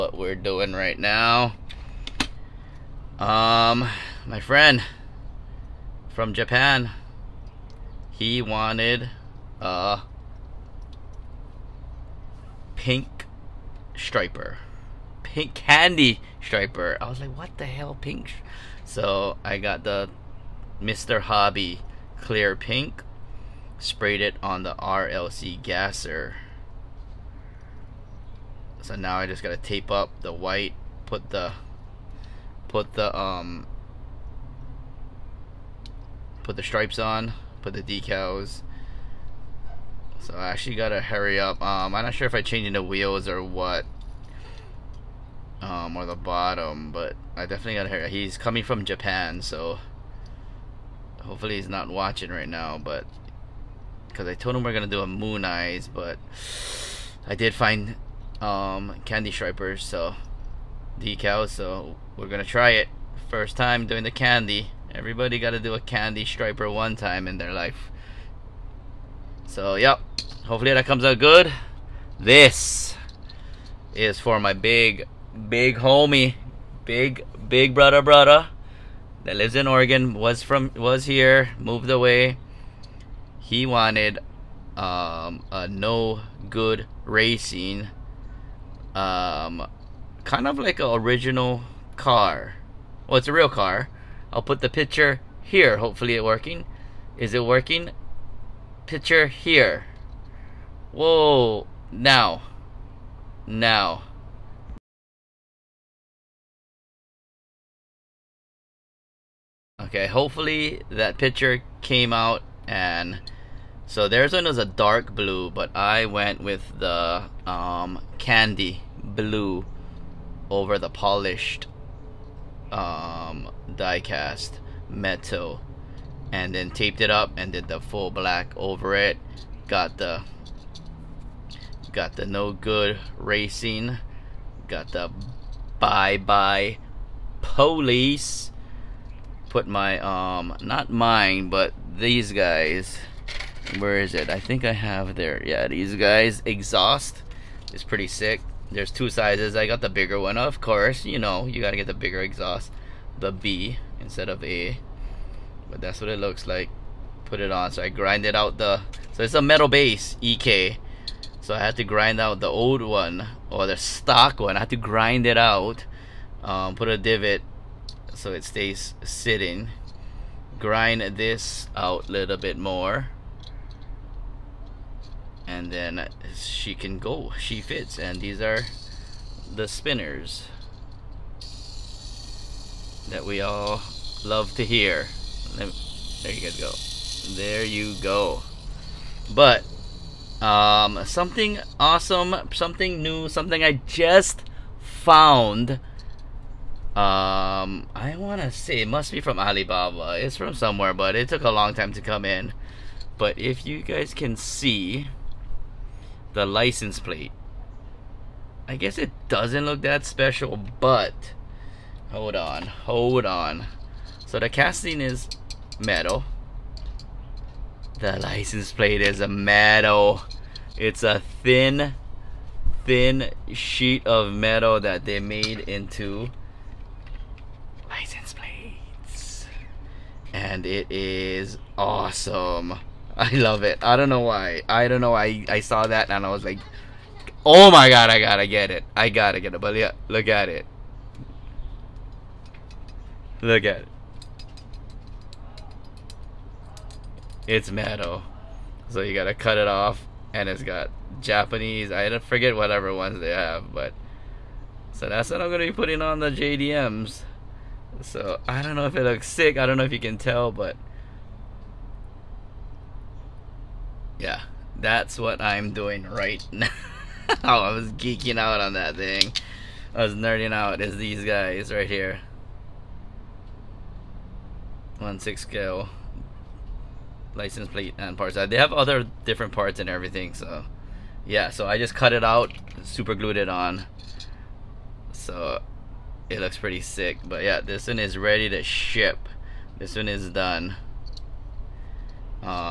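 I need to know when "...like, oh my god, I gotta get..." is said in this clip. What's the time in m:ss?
3:56.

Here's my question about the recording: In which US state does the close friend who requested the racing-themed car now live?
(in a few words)
Oregon.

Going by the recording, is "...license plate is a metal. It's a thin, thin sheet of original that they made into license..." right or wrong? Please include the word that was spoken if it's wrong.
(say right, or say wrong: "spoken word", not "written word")
wrong: "metal", not "original".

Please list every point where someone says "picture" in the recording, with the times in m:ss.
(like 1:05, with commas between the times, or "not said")
1:34, 1:38, 1:51.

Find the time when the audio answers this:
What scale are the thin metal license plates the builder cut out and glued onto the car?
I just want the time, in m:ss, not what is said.
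4:34.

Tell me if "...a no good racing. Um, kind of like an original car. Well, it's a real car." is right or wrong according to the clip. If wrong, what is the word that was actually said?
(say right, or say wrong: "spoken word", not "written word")
right.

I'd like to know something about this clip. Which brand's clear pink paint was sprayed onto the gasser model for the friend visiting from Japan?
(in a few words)
Mr. Hobby.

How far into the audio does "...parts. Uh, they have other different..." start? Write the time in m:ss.
4:38.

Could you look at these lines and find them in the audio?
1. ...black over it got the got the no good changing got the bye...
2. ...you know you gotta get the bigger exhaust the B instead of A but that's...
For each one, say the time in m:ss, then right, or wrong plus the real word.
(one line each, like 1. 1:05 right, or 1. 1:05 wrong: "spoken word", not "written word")
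1. 2:08 wrong: "racing", not "changing"
2. 2:31 right.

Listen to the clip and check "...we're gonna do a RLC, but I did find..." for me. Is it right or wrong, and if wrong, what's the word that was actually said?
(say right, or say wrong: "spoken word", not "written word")
wrong: "Mooneyes", not "RLC".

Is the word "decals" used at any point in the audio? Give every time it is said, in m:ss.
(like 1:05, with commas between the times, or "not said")
0:37, 1:01.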